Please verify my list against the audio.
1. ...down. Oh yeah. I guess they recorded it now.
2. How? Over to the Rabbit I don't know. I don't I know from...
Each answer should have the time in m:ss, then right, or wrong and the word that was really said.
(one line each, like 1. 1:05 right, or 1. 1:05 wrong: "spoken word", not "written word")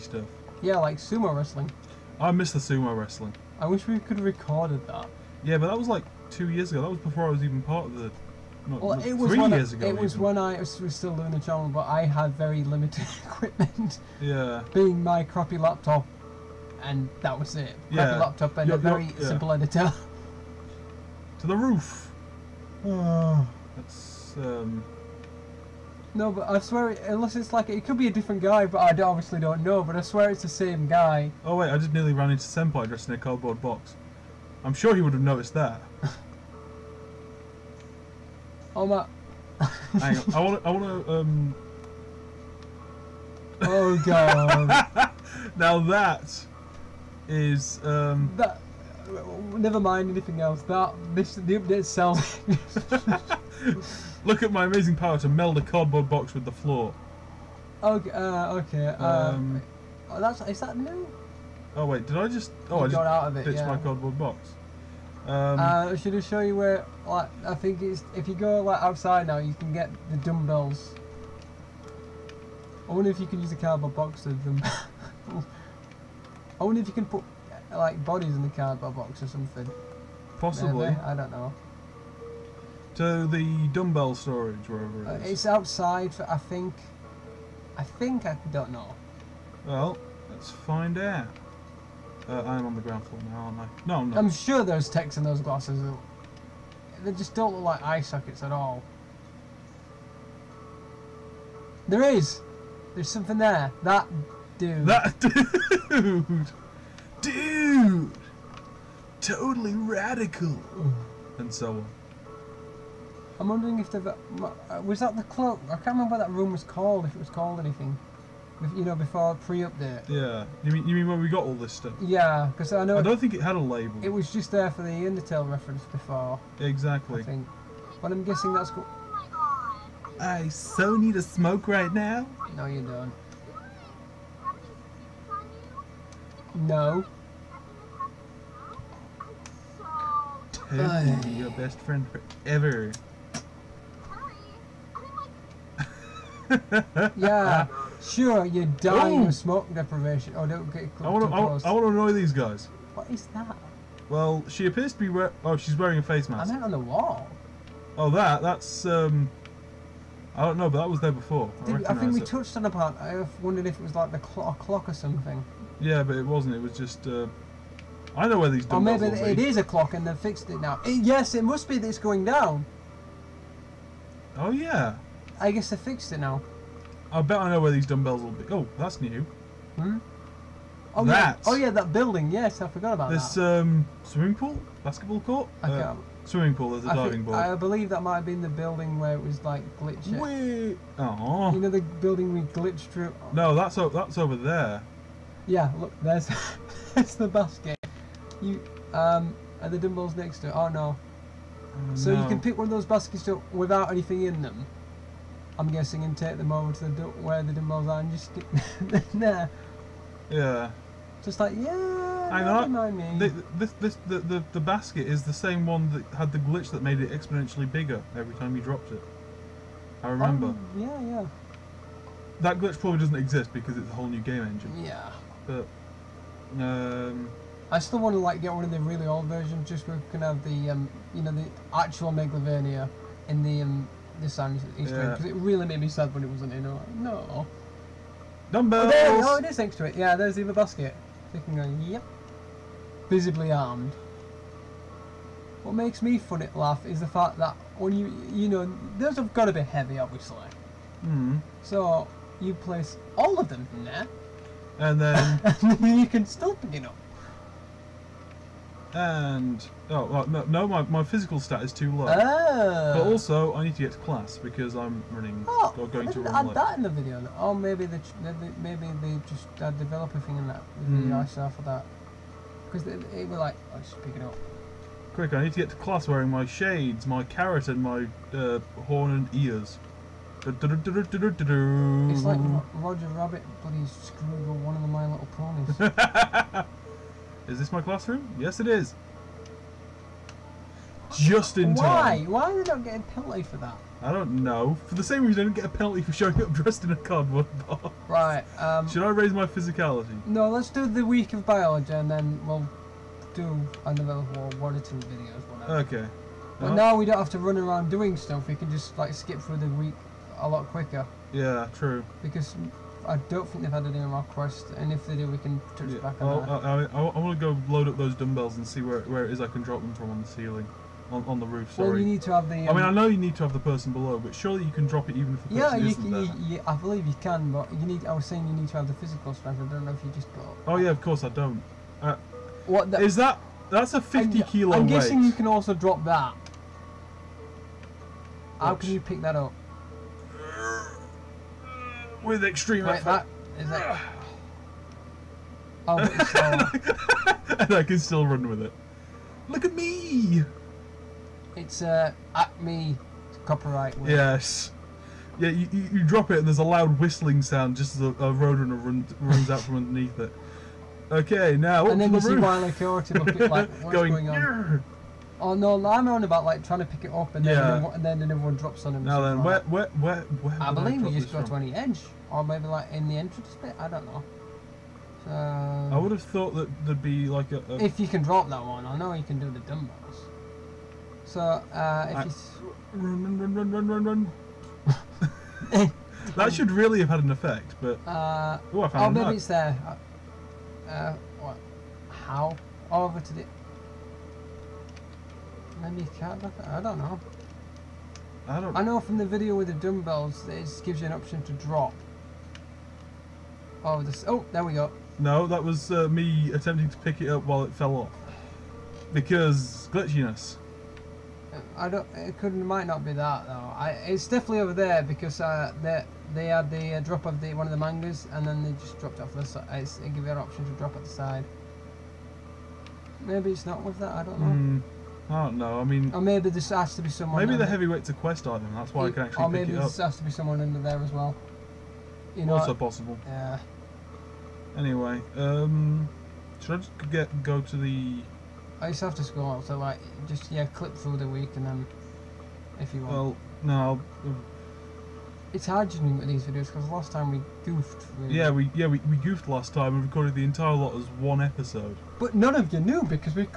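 1. 2:52 wrong: "fixed", not "recorded"
2. 6:32 wrong: "Maybe", not "Rabbit".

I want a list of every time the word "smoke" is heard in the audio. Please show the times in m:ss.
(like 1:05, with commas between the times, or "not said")
2:11, 2:29.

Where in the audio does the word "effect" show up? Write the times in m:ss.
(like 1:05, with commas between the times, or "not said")
6:27.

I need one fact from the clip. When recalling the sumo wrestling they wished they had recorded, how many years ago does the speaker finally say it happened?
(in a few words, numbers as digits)
3.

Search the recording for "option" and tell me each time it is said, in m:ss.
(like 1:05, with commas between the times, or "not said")
6:41, 7:00.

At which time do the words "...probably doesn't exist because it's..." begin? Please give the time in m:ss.
3:42.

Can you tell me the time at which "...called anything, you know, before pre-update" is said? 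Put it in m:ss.
1:57.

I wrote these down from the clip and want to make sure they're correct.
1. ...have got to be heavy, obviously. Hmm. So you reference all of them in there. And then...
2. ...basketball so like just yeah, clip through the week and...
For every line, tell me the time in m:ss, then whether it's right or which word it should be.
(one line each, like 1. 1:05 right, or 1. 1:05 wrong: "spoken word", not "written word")
1. 4:09 wrong: "place", not "reference"
2. 7:19 wrong: "scroll", not "basketball".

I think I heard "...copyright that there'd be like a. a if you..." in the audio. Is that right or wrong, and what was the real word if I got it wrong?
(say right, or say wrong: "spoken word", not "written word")
wrong: "thought", not "copyright".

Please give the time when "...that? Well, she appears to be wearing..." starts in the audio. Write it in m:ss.
2:33.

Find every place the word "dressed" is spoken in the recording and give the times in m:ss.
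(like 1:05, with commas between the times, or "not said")
0:32, 4:56.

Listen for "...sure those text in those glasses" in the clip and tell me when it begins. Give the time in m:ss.
1:34.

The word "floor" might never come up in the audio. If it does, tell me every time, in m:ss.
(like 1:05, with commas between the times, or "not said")
0:56, 1:33.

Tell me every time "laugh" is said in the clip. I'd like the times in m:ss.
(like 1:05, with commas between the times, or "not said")
4:06.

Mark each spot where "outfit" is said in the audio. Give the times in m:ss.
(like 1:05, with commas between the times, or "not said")
not said.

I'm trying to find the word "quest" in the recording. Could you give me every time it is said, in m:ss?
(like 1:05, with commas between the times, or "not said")
5:14, 7:08.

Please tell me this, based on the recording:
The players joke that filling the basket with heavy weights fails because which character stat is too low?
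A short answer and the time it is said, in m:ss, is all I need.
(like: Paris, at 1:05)
physical stat, at 4:21.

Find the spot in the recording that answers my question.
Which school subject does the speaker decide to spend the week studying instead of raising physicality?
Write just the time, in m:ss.
5:01.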